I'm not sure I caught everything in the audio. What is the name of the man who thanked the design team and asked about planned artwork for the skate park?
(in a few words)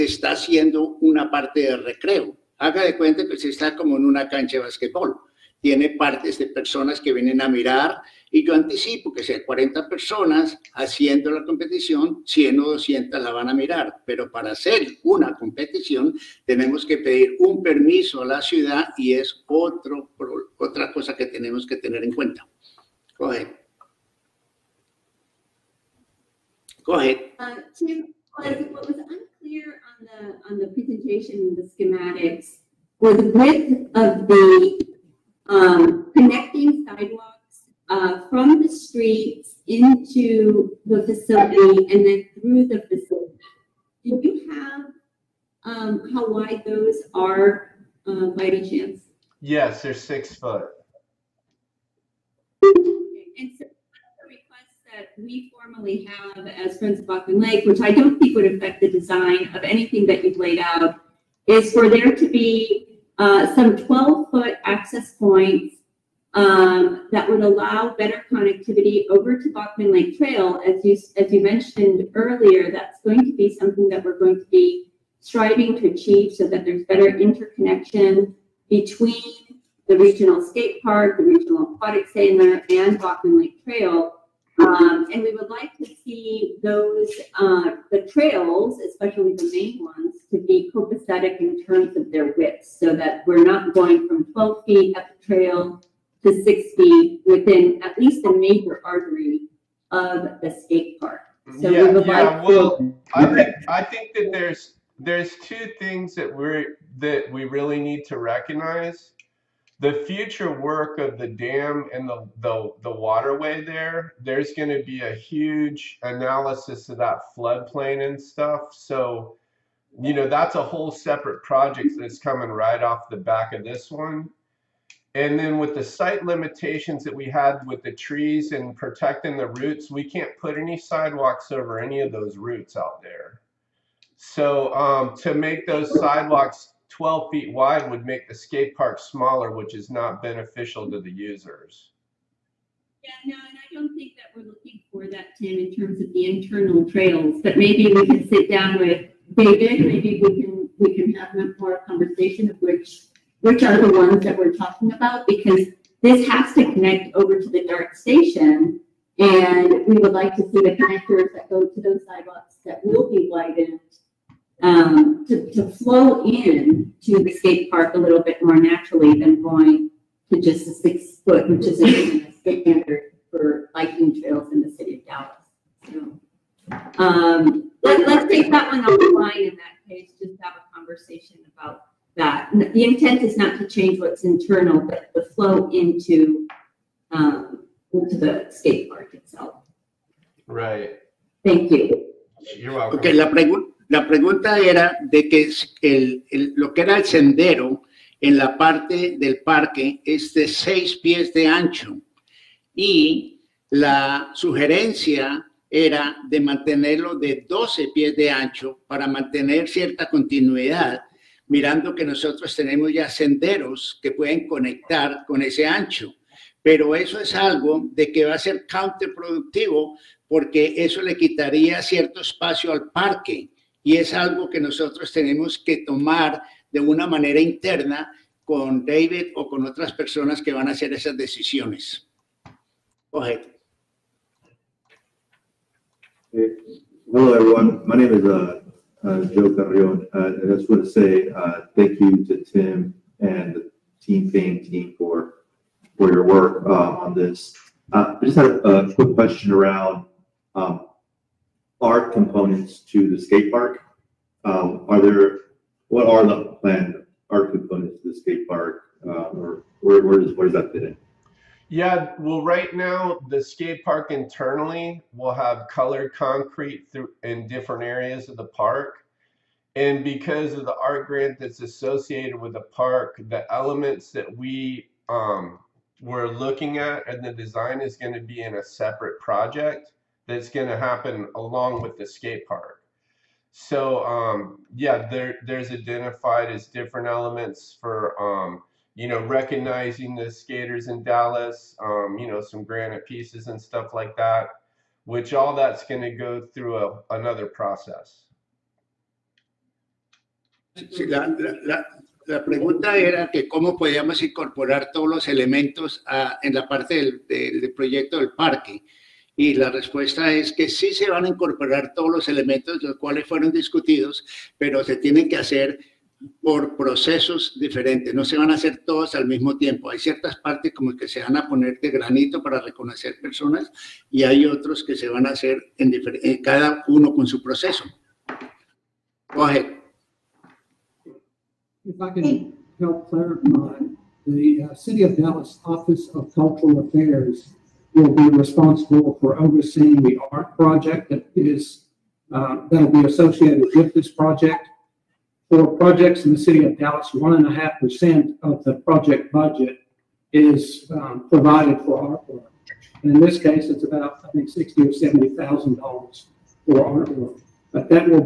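Joe Carrion.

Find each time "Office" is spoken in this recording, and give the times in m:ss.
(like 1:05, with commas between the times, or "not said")
5:35.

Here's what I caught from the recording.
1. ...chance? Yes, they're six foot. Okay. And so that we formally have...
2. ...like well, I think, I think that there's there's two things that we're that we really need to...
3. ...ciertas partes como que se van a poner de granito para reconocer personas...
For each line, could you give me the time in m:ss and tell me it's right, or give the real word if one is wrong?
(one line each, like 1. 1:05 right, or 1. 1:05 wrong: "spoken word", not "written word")
1. 0:48 right
2. 1:42 right
3. 5:19 right.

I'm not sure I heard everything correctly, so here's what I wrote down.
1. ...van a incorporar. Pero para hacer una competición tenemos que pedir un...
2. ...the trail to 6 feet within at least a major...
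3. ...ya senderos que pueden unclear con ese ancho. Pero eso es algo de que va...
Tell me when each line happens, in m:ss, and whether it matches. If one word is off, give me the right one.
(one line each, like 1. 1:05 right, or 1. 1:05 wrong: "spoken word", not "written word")
1. 0:13 wrong: "mirar", not "incorporar"
2. 1:35 right
3. 3:32 wrong: "conectar", not "unclear".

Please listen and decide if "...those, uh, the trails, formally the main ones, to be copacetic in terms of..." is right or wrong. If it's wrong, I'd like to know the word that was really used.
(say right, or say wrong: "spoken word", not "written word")
wrong: "especially", not "formally".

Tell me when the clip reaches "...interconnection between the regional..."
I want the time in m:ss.
1:17.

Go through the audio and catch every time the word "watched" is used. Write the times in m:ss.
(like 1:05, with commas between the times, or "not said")
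not said.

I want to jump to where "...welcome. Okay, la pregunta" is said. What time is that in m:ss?
3:12.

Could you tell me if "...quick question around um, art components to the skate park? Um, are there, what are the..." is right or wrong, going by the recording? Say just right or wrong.
right.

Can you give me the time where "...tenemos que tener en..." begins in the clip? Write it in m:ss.
0:21.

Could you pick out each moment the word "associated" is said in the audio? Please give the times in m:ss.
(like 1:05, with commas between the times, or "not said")
4:31, 5:43.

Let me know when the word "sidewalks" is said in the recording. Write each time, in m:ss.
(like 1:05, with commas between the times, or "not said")
0:36, 2:10, 2:15, 2:42.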